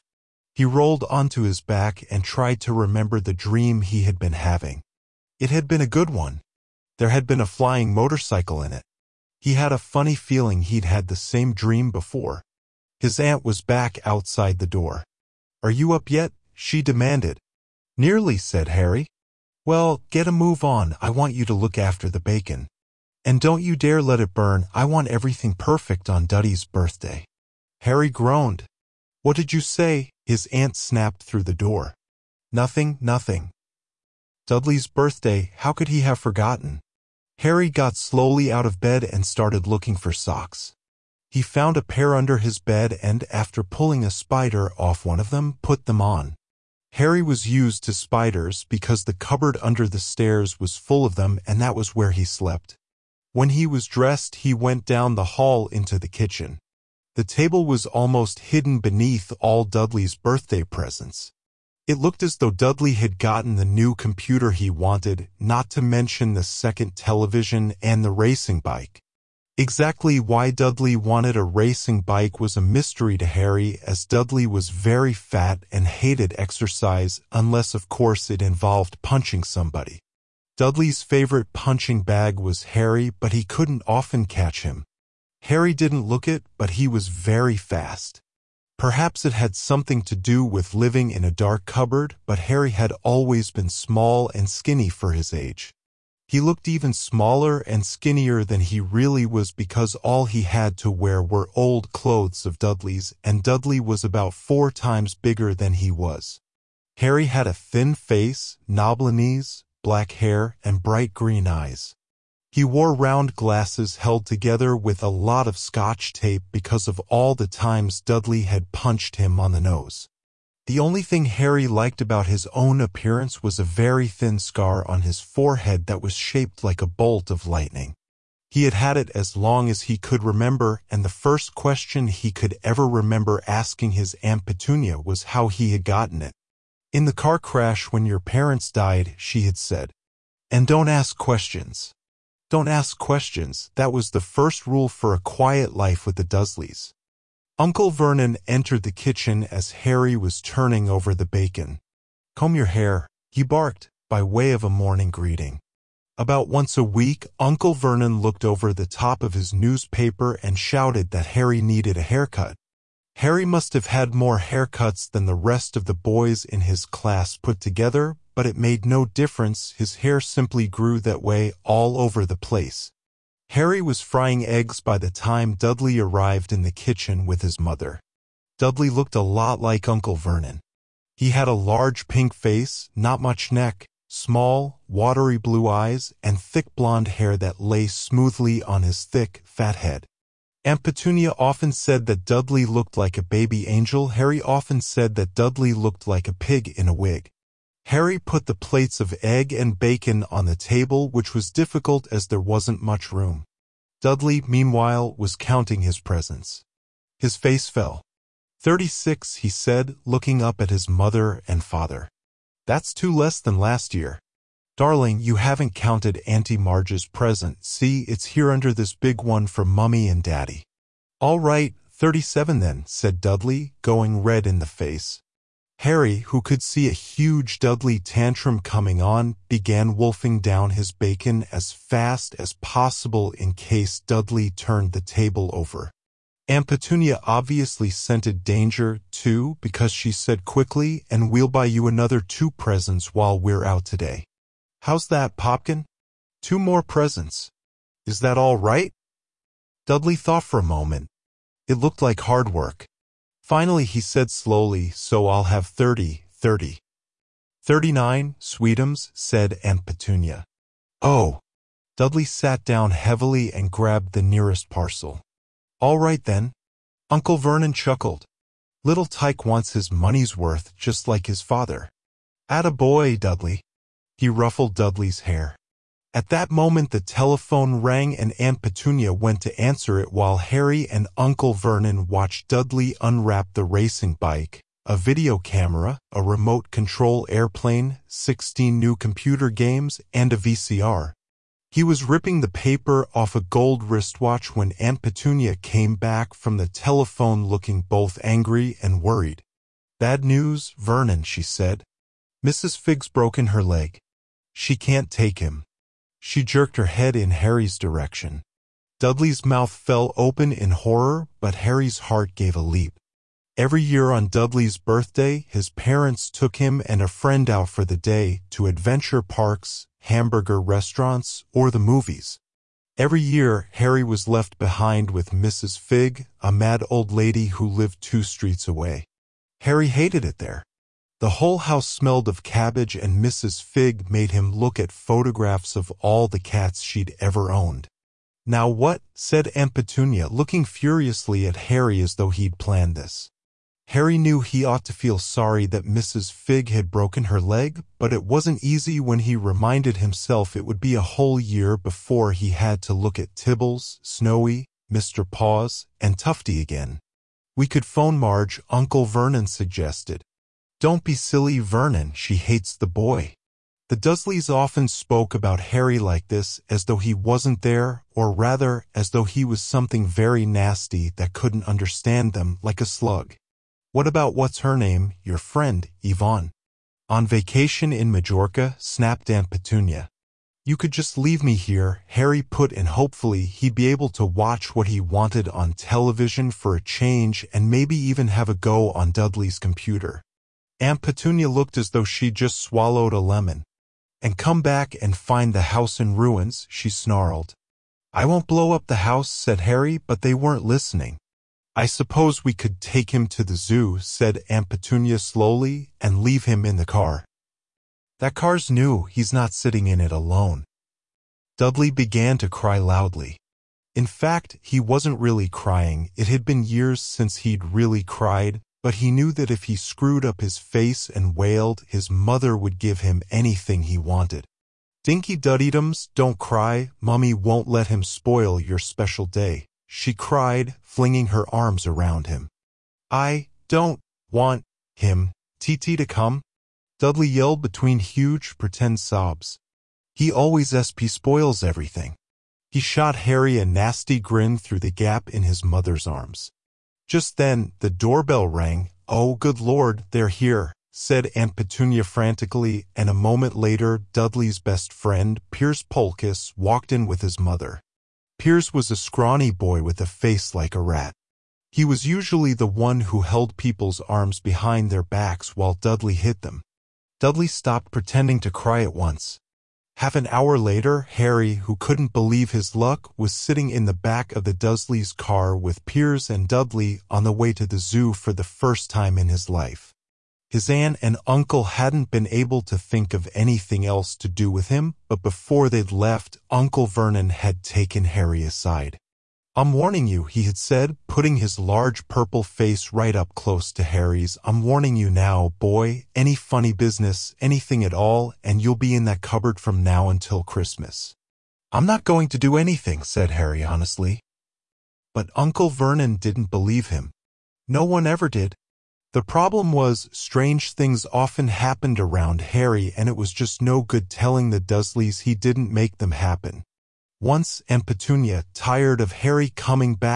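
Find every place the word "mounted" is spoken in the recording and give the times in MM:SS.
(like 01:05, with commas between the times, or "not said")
not said.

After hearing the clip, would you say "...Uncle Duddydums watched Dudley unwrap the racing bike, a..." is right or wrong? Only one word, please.
wrong.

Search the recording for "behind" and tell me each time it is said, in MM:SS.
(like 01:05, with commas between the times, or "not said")
05:24, 07:44.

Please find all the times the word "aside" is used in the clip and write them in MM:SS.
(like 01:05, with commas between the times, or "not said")
08:08.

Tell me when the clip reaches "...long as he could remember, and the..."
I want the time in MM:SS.
02:09.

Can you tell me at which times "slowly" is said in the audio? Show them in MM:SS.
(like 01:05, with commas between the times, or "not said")
00:37, 04:14, 06:45.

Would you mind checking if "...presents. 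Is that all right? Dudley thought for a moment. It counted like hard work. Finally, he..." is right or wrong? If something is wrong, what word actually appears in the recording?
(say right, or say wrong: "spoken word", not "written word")
wrong: "looked", not "counted".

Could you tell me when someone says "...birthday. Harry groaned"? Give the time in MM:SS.
00:26.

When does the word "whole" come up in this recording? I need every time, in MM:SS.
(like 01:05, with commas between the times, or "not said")
05:31, 05:50.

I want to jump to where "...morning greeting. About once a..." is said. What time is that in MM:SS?
02:34.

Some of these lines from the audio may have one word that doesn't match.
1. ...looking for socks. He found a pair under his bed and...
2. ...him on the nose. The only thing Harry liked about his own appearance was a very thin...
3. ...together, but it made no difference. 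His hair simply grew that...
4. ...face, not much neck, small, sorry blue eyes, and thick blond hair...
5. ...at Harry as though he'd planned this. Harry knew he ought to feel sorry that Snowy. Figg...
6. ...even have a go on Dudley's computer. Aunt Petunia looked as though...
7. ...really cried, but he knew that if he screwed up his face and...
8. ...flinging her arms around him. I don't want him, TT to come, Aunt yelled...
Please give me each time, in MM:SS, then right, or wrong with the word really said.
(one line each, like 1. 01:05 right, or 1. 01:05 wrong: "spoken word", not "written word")
1. 00:39 right
2. 01:59 right
3. 02:47 right
4. 03:02 wrong: "watery", not "sorry"
5. 05:41 wrong: "Mrs", not "Snowy"
6. 06:27 right
7. 06:57 right
8. 07:10 wrong: "Dudley", not "Aunt".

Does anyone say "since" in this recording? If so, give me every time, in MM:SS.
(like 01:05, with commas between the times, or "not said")
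06:56.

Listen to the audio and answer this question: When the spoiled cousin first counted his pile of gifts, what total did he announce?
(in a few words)
36.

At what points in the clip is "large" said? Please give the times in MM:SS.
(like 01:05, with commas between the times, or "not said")
03:01, 08:11.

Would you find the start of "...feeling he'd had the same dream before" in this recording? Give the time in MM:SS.
00:10.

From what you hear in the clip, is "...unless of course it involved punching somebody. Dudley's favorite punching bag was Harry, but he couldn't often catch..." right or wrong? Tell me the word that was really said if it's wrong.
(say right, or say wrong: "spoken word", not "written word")
right.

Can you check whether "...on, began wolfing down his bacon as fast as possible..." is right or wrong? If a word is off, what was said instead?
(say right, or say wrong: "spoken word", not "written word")
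right.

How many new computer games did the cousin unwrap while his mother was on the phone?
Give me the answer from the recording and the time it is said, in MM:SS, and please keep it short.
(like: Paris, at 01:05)
16, at 04:48.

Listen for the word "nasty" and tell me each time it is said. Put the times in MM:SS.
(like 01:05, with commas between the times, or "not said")
06:10, 07:23.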